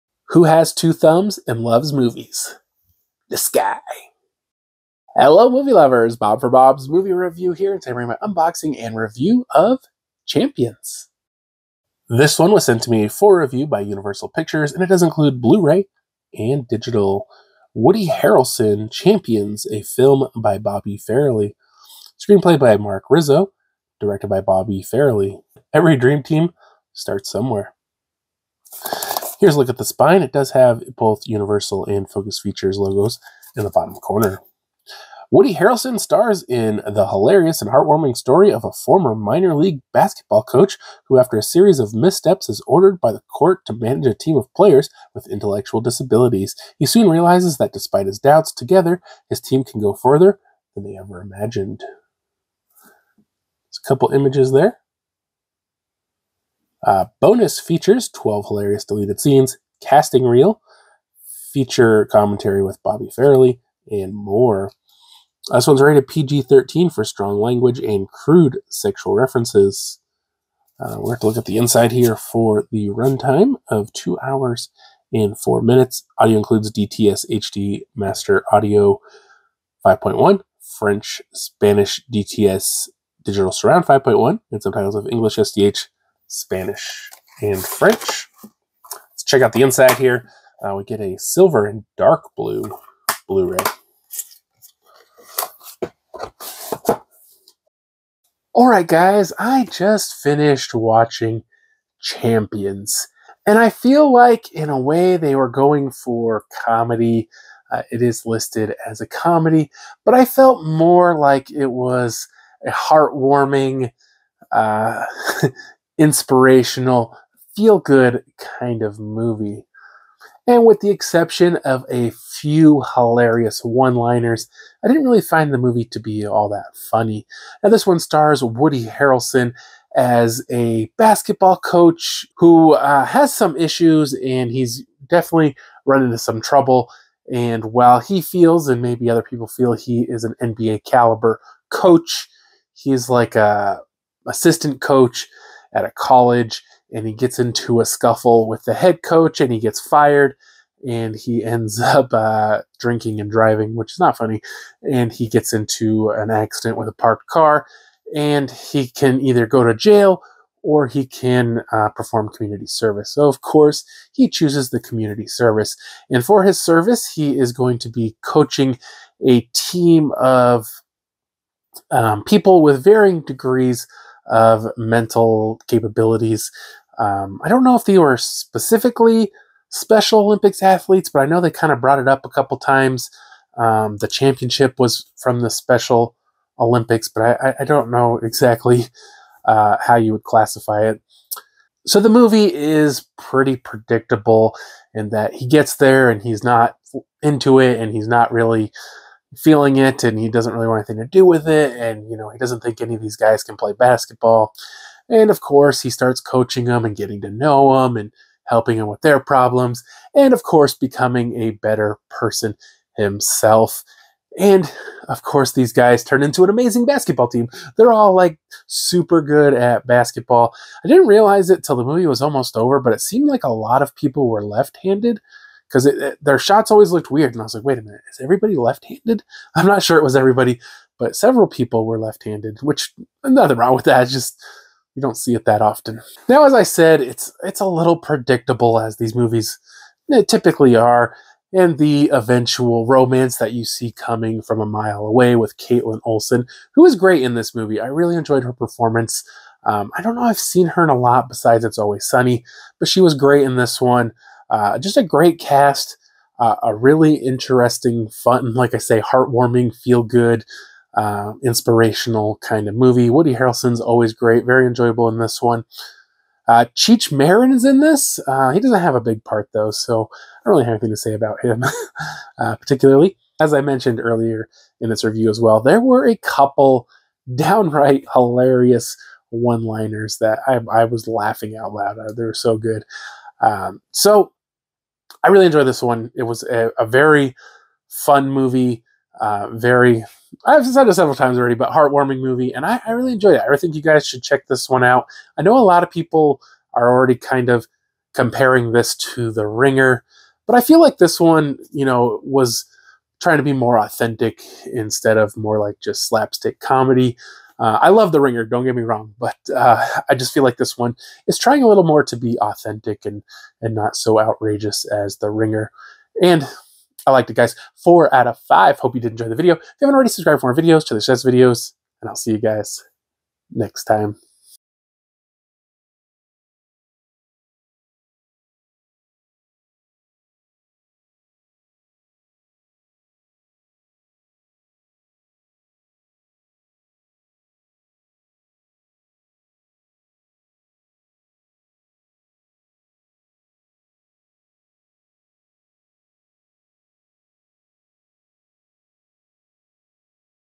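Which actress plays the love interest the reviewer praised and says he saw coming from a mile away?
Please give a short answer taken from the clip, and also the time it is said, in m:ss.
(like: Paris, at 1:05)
Kaitlin Olson, at 4:05.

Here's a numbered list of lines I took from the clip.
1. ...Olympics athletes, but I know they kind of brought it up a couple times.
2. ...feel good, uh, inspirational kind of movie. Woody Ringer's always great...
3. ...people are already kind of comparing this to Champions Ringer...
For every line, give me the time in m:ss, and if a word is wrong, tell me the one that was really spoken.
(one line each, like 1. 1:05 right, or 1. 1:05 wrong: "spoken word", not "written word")
1. 3:00 right
2. 4:19 wrong: "Harrelson", not "Ringer"
3. 4:55 wrong: "The", not "Champions".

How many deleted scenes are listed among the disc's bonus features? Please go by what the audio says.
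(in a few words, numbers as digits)
12.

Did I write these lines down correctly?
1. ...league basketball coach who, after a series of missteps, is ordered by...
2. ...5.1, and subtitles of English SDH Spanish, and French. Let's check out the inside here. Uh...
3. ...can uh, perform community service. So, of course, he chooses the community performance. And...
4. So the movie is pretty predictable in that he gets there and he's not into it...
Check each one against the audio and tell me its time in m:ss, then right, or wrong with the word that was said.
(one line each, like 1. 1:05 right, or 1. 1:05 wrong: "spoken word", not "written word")
1. 0:39 right
2. 1:23 right
3. 2:41 wrong: "service", not "performance"
4. 3:11 right.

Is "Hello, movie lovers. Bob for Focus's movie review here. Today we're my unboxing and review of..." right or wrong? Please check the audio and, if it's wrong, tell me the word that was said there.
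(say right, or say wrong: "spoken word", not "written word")
wrong: "Bob", not "Focus".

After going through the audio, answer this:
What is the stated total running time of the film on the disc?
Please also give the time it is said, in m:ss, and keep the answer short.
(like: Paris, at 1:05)
2 hours 4 minutes, at 1:13.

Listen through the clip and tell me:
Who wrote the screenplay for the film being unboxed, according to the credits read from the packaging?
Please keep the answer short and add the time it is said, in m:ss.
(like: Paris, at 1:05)
Mark Rizzo, at 0:22.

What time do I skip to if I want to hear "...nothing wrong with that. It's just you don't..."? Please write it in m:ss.
3:53.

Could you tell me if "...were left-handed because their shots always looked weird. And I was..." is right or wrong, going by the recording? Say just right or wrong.
right.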